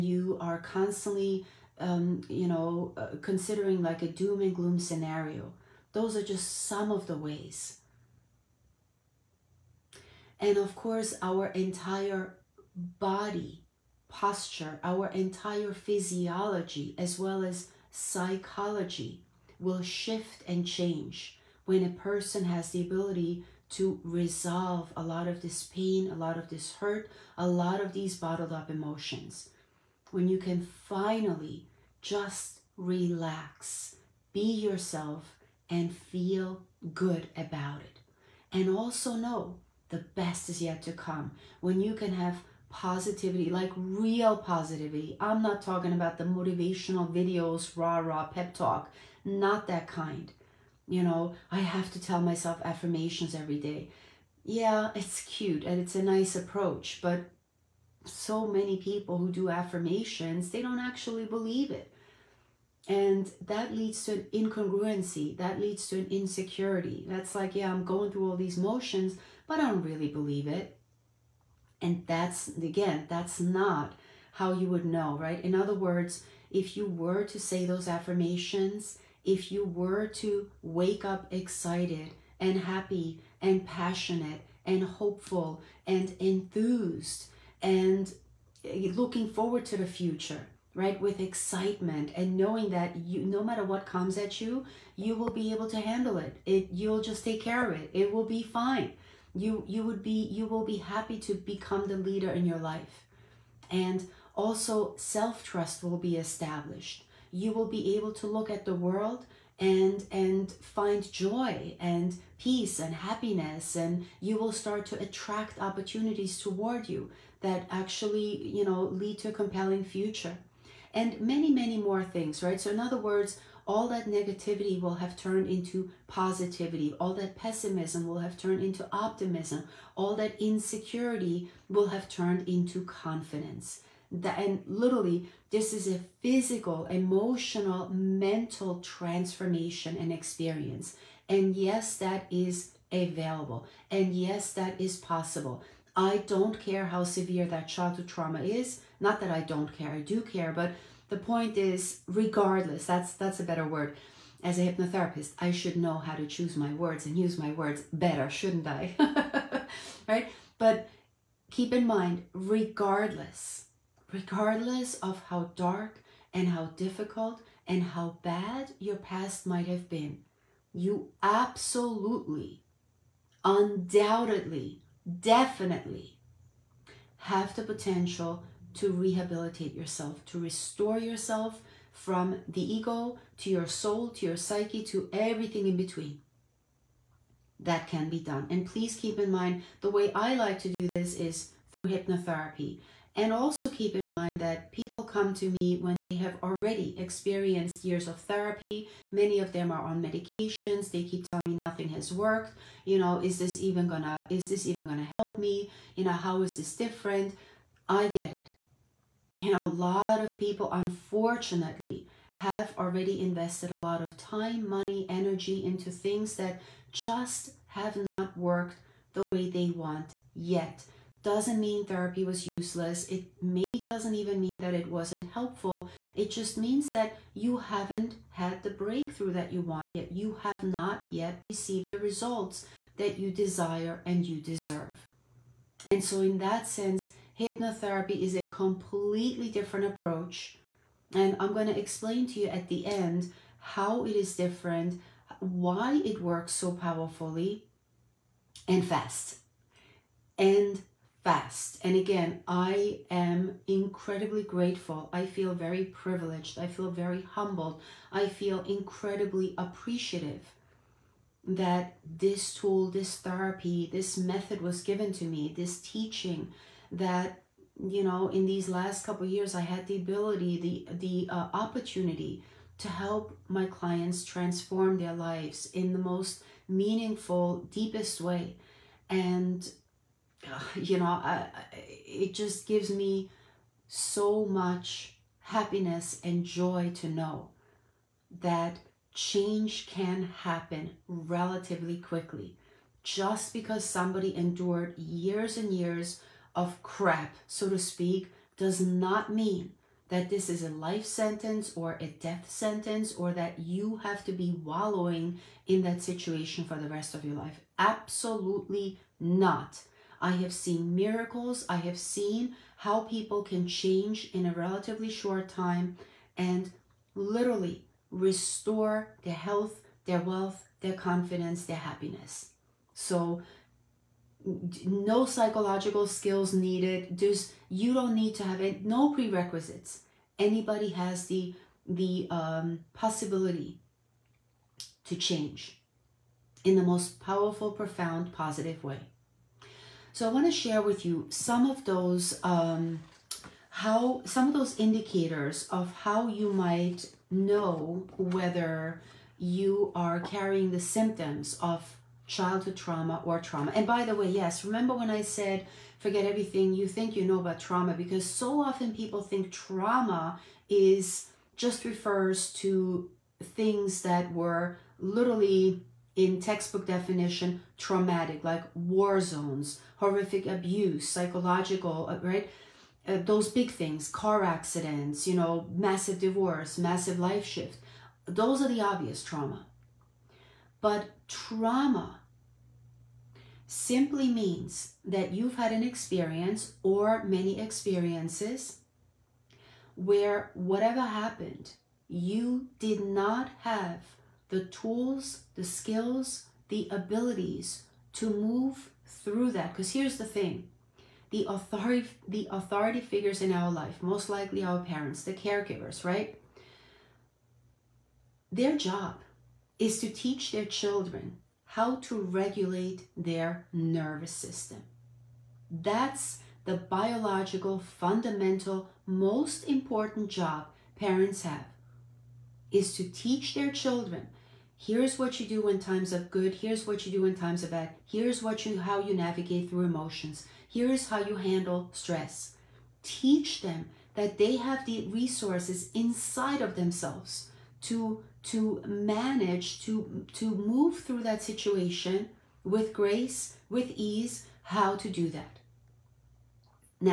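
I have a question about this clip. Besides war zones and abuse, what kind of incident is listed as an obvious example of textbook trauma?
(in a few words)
car accidents.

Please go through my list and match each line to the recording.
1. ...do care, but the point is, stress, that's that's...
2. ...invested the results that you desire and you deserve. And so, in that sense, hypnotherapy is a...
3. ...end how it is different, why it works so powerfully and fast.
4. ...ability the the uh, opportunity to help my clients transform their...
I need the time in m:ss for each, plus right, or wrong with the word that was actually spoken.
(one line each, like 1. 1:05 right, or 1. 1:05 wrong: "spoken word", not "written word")
1. 2:29 wrong: "regardless", not "stress"
2. 3:51 wrong: "received", not "invested"
3. 4:02 right
4. 4:29 right.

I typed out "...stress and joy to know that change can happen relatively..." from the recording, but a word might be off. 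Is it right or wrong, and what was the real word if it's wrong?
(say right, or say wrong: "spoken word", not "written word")
wrong: "happiness", not "stress".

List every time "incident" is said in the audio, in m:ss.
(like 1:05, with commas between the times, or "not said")
not said.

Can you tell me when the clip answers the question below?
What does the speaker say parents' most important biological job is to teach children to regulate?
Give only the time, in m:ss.
6:53.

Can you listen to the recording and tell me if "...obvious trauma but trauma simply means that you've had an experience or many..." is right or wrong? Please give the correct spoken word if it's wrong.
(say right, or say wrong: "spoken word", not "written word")
right.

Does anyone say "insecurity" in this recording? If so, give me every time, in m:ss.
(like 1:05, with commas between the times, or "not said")
1:06, 2:10.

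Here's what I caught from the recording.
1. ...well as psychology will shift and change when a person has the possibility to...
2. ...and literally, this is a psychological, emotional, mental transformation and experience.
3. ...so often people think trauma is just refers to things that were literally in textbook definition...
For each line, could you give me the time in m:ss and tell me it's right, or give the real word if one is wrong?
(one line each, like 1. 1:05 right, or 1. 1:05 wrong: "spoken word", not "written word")
1. 0:17 wrong: "ability", not "possibility"
2. 2:14 wrong: "physical", not "psychological"
3. 5:58 right.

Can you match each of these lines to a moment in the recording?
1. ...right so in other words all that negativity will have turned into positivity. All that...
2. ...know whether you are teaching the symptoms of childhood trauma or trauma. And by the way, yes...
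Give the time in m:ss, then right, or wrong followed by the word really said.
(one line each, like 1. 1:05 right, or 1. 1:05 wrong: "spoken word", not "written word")
1. 2:02 right
2. 5:47 wrong: "carrying", not "teaching".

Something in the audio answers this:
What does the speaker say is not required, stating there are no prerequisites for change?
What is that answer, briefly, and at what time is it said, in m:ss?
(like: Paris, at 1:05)
psychological skills, at 5:25.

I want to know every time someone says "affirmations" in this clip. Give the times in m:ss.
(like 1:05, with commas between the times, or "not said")
0:52, 0:59, 1:17.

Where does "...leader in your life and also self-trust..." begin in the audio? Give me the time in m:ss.
1:41.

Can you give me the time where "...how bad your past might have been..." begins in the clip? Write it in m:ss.
2:47.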